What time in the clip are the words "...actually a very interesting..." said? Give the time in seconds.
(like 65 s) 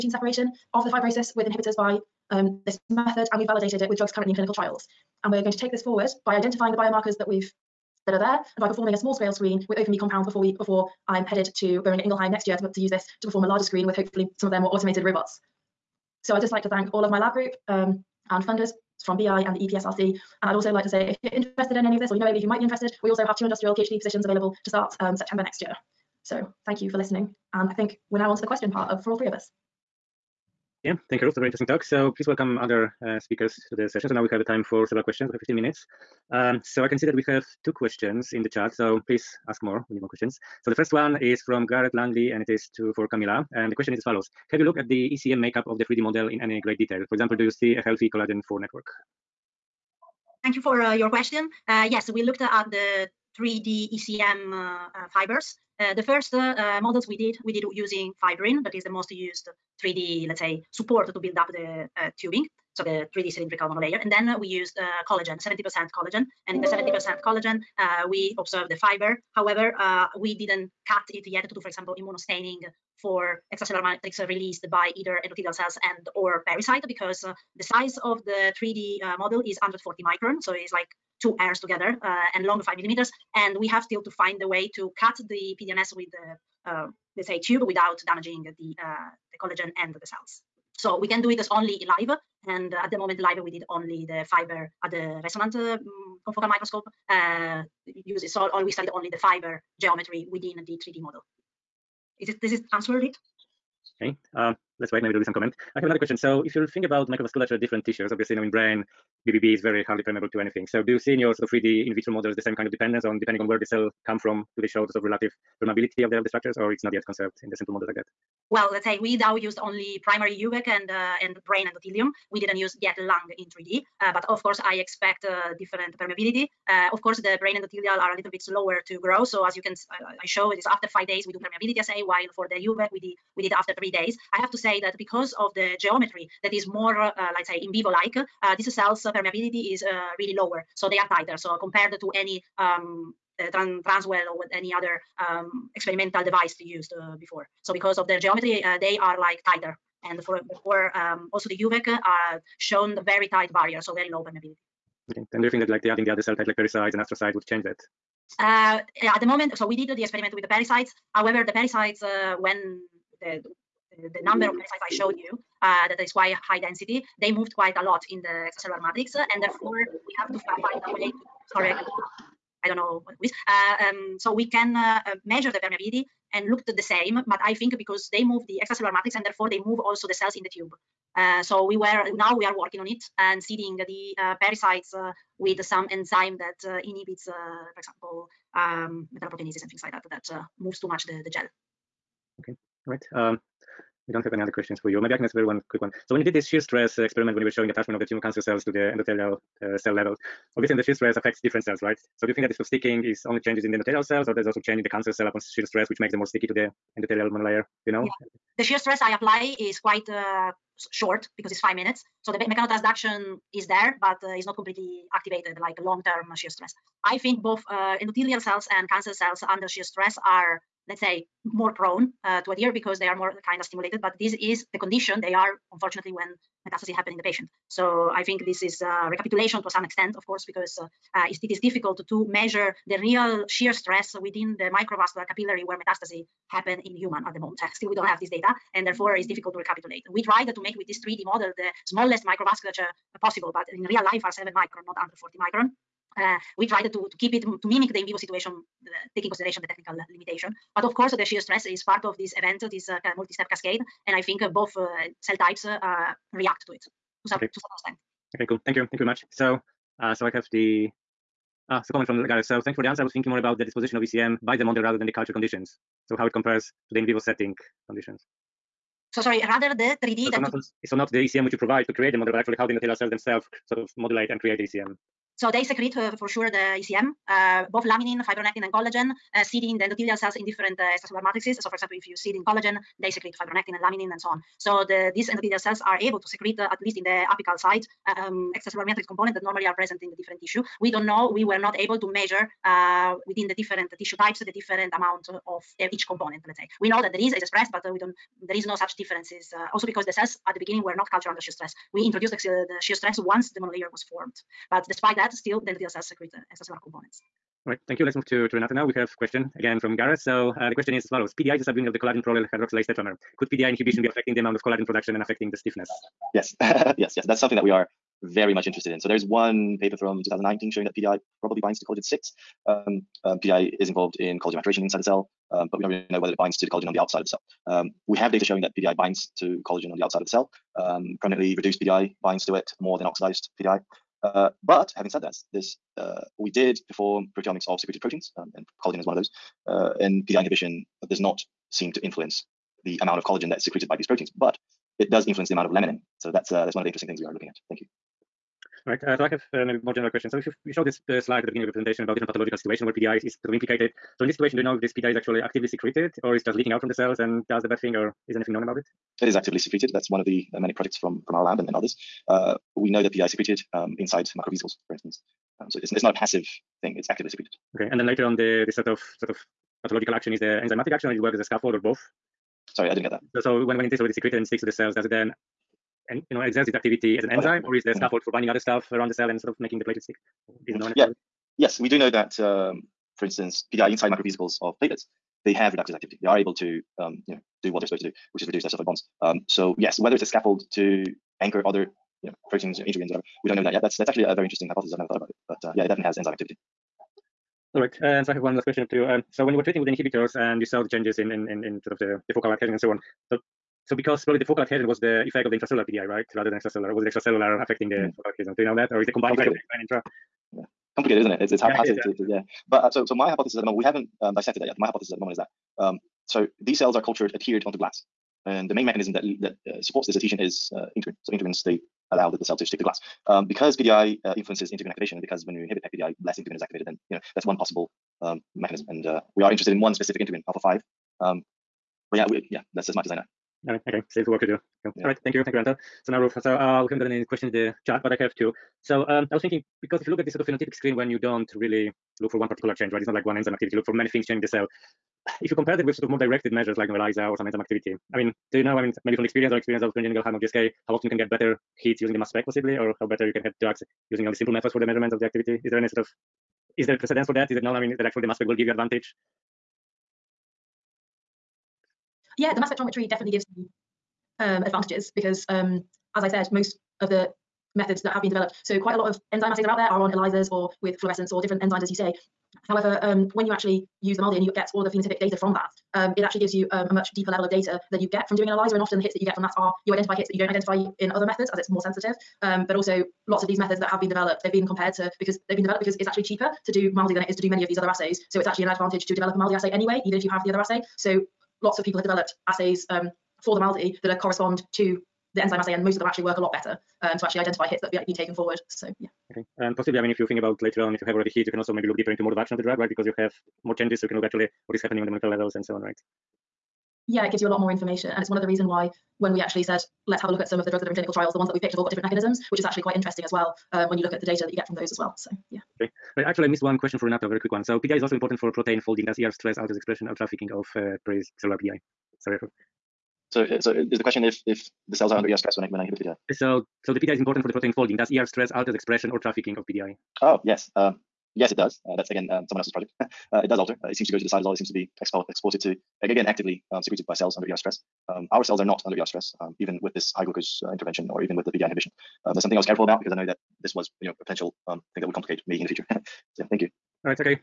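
394 s.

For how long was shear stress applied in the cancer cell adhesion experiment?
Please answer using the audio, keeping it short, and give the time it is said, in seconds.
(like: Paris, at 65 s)
5 minutes, at 211 s.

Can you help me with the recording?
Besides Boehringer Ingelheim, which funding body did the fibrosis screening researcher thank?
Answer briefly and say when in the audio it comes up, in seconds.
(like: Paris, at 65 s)
EPSRC, at 19 s.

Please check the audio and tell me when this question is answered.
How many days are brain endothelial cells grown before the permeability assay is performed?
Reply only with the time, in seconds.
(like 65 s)
130 s.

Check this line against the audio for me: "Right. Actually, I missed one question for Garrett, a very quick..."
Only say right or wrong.
wrong.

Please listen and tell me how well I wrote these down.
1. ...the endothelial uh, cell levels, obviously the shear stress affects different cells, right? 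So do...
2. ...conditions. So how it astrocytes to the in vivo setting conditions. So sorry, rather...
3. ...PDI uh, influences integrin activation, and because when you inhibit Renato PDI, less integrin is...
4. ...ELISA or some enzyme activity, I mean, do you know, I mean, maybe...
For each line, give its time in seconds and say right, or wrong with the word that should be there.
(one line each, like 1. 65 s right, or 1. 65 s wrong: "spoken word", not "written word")
1. 198 s right
2. 265 s wrong: "compares", not "astrocytes"
3. 423 s wrong: "PEC", not "Renato"
4. 446 s right.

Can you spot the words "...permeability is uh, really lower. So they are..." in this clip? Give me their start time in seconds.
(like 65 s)
139 s.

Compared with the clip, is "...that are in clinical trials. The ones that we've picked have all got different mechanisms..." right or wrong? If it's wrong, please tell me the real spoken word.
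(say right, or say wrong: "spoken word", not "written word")
right.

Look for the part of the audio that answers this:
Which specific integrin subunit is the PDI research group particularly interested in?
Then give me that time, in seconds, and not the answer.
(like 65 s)
430 s.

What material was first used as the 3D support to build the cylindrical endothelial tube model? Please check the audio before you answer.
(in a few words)
fibrin.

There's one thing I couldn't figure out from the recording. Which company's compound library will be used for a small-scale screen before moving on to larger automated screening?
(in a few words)
opnMe.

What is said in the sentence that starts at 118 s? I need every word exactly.
Well, let's say we now used only primary UVEC and uh, and brain endothelium.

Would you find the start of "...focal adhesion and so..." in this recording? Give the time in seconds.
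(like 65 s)
402 s.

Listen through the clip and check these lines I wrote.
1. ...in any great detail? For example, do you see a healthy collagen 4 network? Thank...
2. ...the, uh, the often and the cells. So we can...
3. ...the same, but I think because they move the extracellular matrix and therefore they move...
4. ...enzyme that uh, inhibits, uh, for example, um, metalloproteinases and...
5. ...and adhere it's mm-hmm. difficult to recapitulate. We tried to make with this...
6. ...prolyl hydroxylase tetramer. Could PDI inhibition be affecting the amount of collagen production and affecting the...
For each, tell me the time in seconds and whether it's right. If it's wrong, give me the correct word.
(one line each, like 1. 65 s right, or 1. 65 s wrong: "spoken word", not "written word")
1. 46 s right
2. 88 s wrong: "collagen", not "often"
3. 176 s right
4. 185 s right
5. 238 s wrong: "therefore", not "adhere"
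6. 312 s right.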